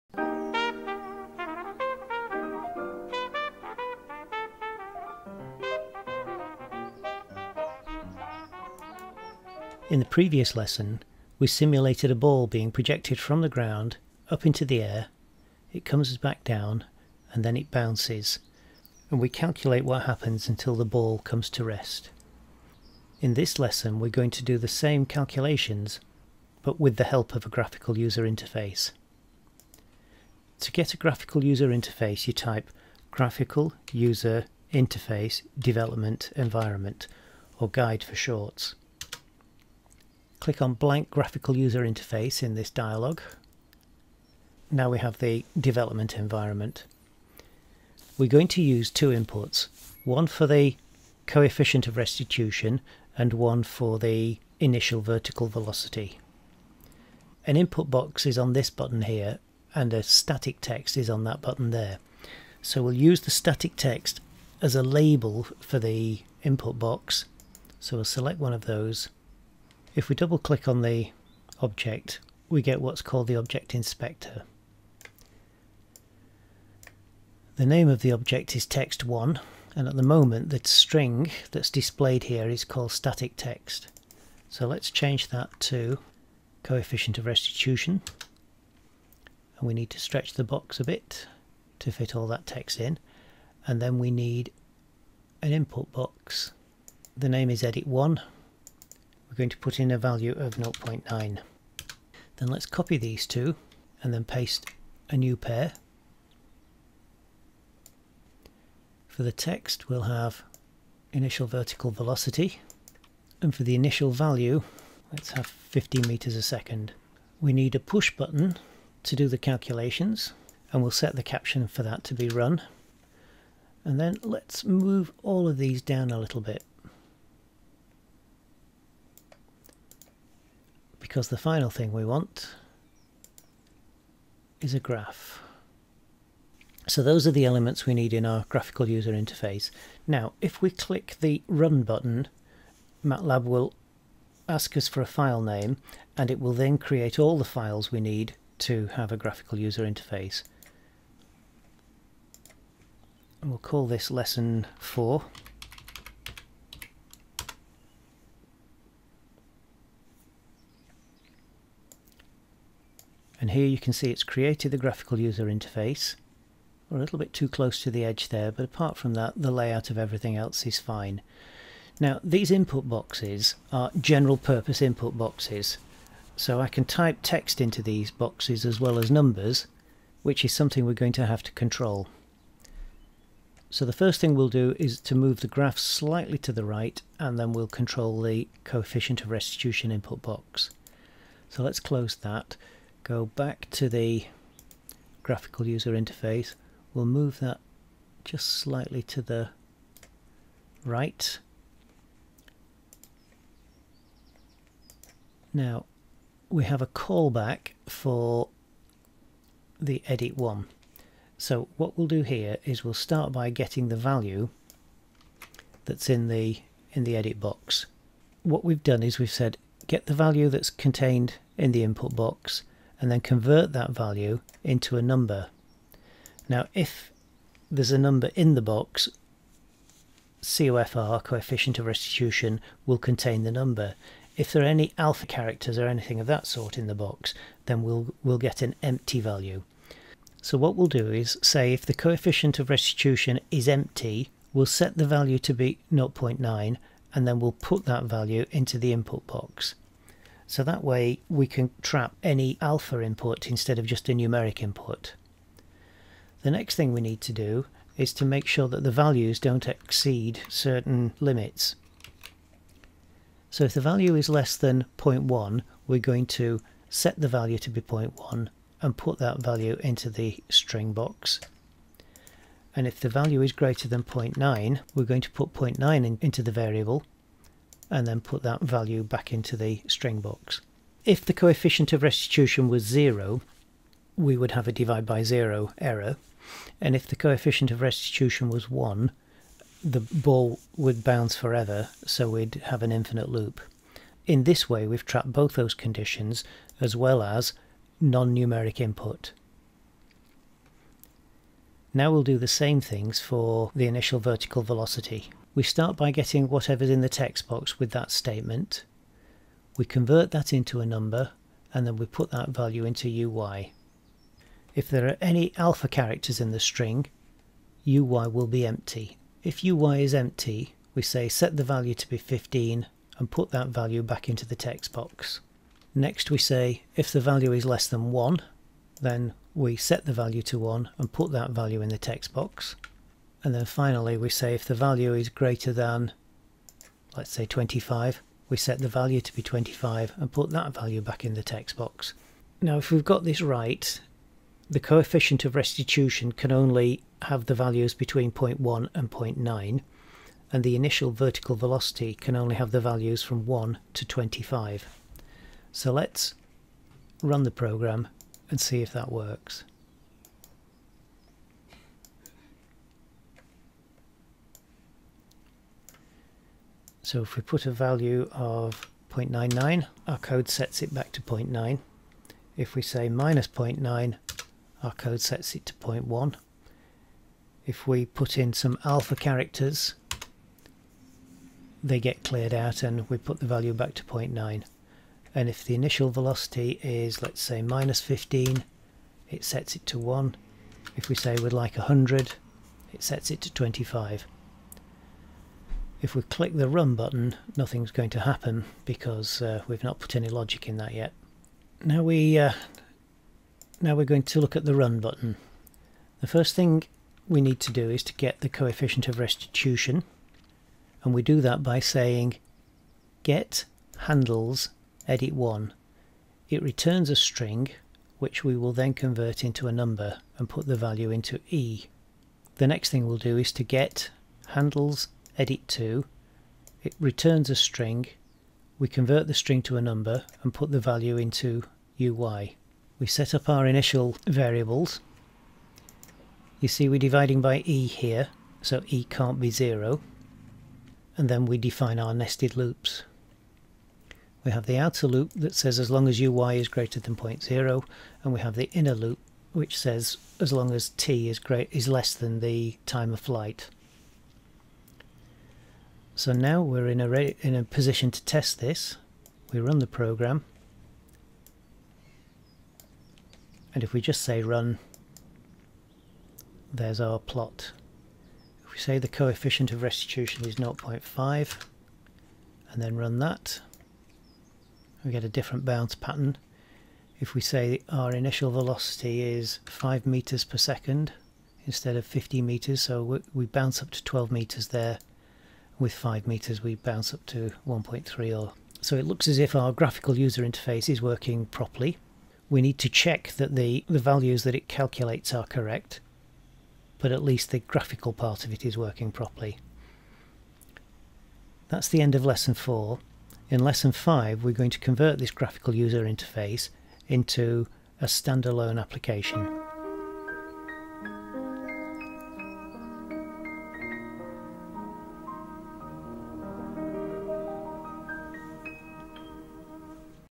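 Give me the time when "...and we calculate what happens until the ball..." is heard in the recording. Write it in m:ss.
0:19.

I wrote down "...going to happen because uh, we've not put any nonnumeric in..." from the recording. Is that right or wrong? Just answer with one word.
wrong.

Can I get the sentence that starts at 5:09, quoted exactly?
We convert that into a number and then we put that value into UY.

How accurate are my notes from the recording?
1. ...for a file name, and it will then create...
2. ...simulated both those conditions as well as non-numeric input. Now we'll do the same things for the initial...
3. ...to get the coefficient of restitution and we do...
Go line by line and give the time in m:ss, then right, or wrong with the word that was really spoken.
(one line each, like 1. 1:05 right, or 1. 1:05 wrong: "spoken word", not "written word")
1. 2:24 right
2. 4:55 wrong: "trapped", not "simulated"
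3. 6:48 right.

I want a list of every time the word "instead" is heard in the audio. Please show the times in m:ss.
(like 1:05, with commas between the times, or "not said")
4:13, 8:01.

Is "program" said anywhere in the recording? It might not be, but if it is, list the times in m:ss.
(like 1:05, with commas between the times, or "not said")
5:57, 7:39.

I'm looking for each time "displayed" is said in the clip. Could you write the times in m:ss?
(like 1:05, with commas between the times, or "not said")
1:21.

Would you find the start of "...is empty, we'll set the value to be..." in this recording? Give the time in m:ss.
4:03.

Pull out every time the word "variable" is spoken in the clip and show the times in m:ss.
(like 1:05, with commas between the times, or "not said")
4:36, 7:14.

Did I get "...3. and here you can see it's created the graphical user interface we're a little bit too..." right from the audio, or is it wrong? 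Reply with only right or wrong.
wrong.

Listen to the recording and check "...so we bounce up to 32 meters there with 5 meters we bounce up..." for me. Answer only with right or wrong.
wrong.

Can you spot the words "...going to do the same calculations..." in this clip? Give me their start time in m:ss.
0:24.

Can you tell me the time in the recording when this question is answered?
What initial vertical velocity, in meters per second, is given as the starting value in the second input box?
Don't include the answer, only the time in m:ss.
1:55.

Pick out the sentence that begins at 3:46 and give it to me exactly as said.
Now if there's a number in the box, COFR, coefficient of restitution, will contain the number.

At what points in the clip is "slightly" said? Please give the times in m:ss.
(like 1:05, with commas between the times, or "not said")
3:05, 3:18.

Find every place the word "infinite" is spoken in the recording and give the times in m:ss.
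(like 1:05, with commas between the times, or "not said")
4:52.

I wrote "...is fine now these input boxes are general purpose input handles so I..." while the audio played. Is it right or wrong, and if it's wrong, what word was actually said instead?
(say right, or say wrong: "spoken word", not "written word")
wrong: "boxes", not "handles".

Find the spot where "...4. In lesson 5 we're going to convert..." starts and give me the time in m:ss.
8:22.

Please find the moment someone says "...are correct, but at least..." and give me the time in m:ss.
8:15.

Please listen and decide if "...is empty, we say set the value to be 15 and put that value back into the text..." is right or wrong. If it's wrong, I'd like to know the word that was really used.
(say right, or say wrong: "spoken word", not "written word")
right.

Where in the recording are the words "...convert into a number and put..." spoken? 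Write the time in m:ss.
6:58.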